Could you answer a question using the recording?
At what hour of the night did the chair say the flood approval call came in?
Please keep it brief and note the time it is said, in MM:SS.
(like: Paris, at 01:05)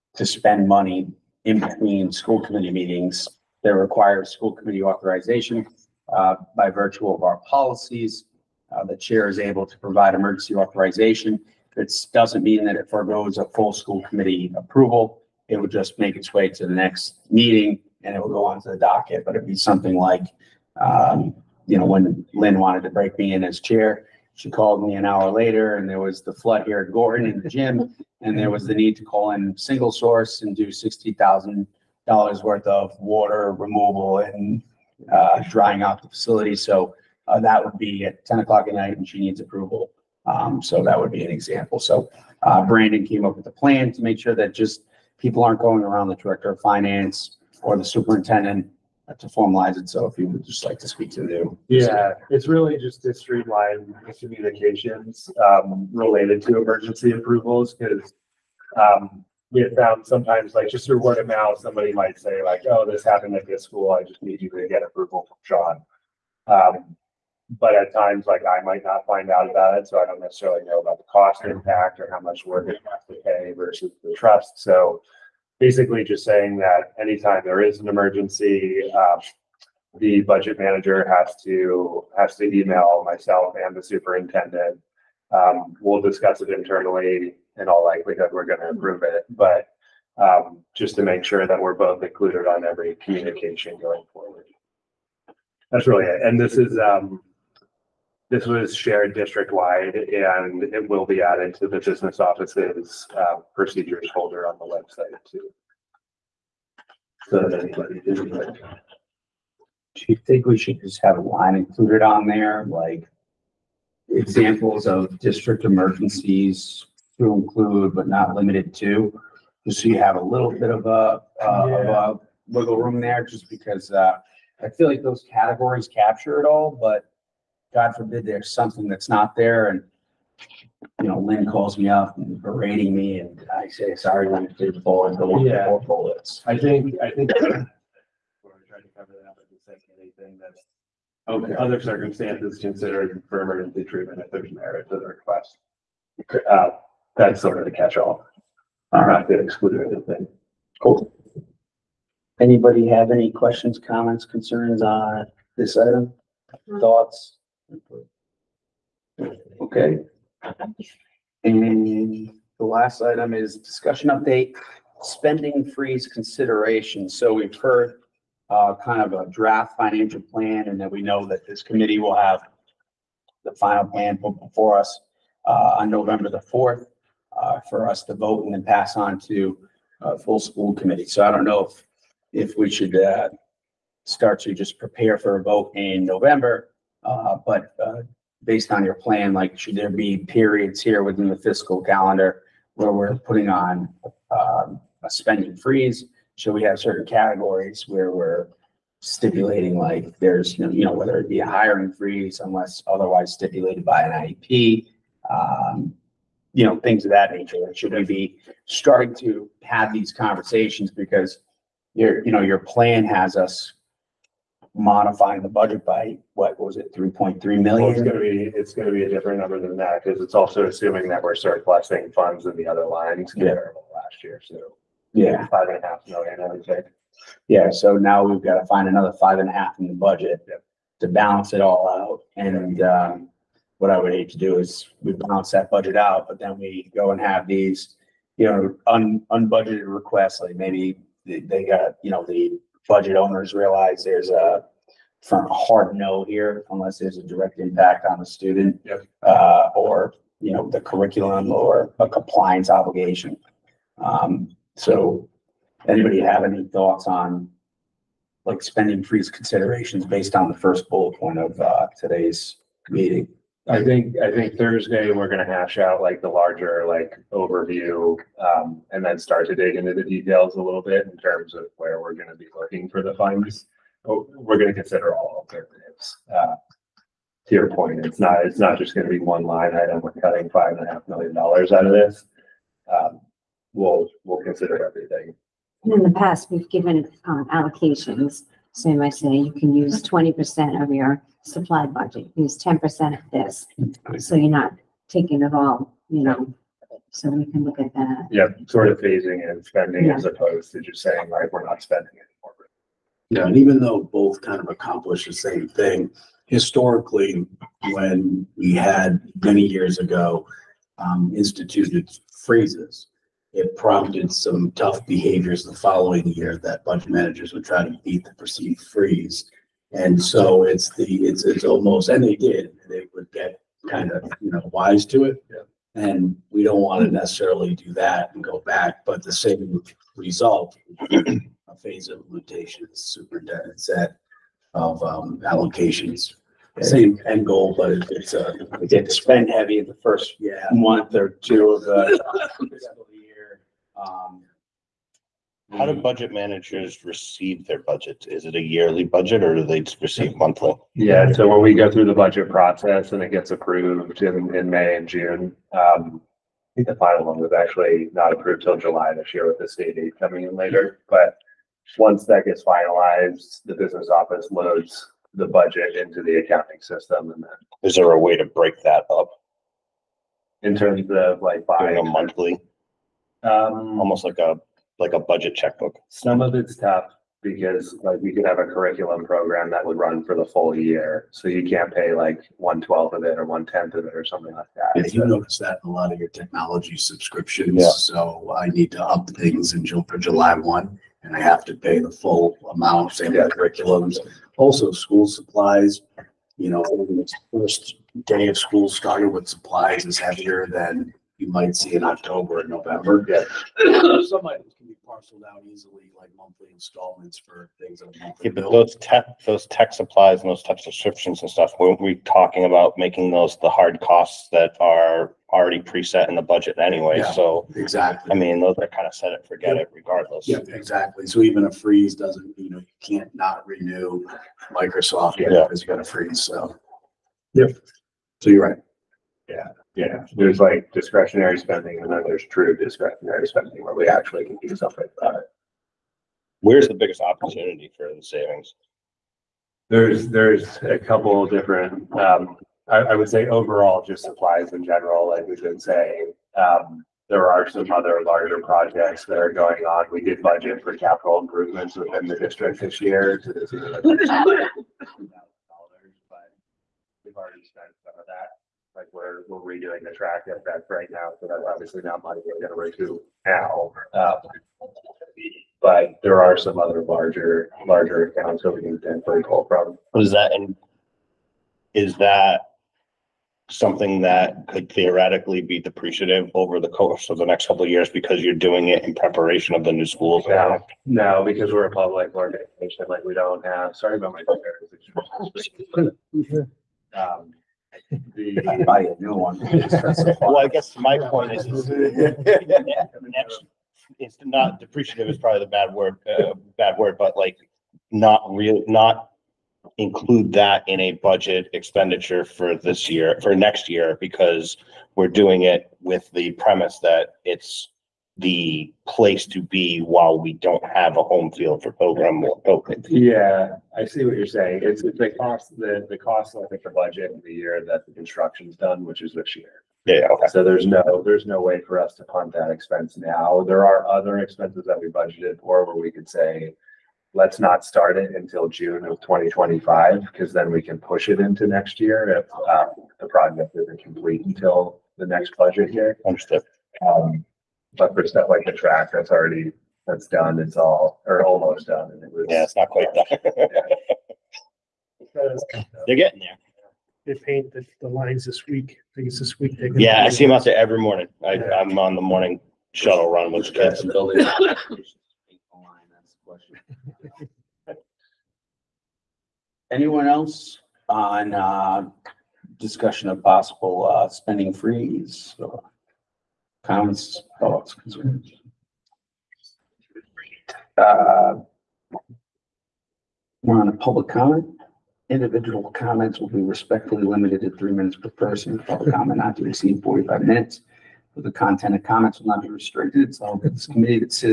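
10 o'clock, at 00:38.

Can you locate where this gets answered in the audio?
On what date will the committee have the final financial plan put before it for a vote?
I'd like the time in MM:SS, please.
02:55.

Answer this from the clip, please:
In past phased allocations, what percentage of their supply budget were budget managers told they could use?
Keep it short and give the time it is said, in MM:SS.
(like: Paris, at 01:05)
20 percent, at 04:50.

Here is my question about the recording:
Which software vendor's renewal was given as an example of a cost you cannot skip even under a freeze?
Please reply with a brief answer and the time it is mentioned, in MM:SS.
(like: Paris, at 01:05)
Microsoft, at 07:04.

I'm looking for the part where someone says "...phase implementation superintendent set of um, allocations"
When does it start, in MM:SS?
05:31.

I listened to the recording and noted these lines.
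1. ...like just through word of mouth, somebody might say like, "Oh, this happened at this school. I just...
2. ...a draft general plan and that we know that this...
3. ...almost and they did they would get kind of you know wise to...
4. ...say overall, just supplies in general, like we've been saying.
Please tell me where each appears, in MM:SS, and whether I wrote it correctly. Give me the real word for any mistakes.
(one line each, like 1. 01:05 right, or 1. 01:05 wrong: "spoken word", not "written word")
1. 01:00 right
2. 02:49 wrong: "financial", not "general"
3. 05:21 right
4. 07:23 right.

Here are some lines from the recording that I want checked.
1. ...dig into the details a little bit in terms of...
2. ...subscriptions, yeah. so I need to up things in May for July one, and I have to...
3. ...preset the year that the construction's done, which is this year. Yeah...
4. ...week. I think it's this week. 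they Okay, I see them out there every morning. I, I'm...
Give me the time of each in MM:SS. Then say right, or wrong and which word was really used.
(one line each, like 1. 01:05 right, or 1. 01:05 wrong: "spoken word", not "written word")
1. 04:29 right
2. 06:26 wrong: "June", not "May"
3. 08:36 wrong: "budget", not "preset"
4. 09:08 wrong: "Yeah", not "Okay".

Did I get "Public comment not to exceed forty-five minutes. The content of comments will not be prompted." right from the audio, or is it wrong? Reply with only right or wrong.
wrong.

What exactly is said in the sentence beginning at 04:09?
uh, or, you know, the curriculum or a compliance obligation.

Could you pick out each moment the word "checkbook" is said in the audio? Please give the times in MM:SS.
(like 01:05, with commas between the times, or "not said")
06:15.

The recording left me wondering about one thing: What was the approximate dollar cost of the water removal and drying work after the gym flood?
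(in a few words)
$60,000.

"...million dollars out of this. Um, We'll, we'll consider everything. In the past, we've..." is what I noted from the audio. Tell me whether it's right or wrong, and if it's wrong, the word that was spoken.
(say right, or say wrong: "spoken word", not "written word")
right.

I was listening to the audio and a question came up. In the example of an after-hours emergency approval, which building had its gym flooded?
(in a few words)
Gorton.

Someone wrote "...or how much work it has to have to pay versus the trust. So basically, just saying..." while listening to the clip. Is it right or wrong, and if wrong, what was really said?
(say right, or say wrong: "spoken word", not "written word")
right.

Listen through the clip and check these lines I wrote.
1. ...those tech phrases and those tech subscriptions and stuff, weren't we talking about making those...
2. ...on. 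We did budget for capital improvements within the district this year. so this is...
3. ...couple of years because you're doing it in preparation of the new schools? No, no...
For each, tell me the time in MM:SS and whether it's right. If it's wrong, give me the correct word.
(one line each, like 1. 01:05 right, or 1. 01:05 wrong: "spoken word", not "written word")
1. 06:49 wrong: "supplies", not "phrases"
2. 07:29 right
3. 07:57 right.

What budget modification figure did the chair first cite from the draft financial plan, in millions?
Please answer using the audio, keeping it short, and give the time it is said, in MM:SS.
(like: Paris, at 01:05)
3.3 million, at 03:36.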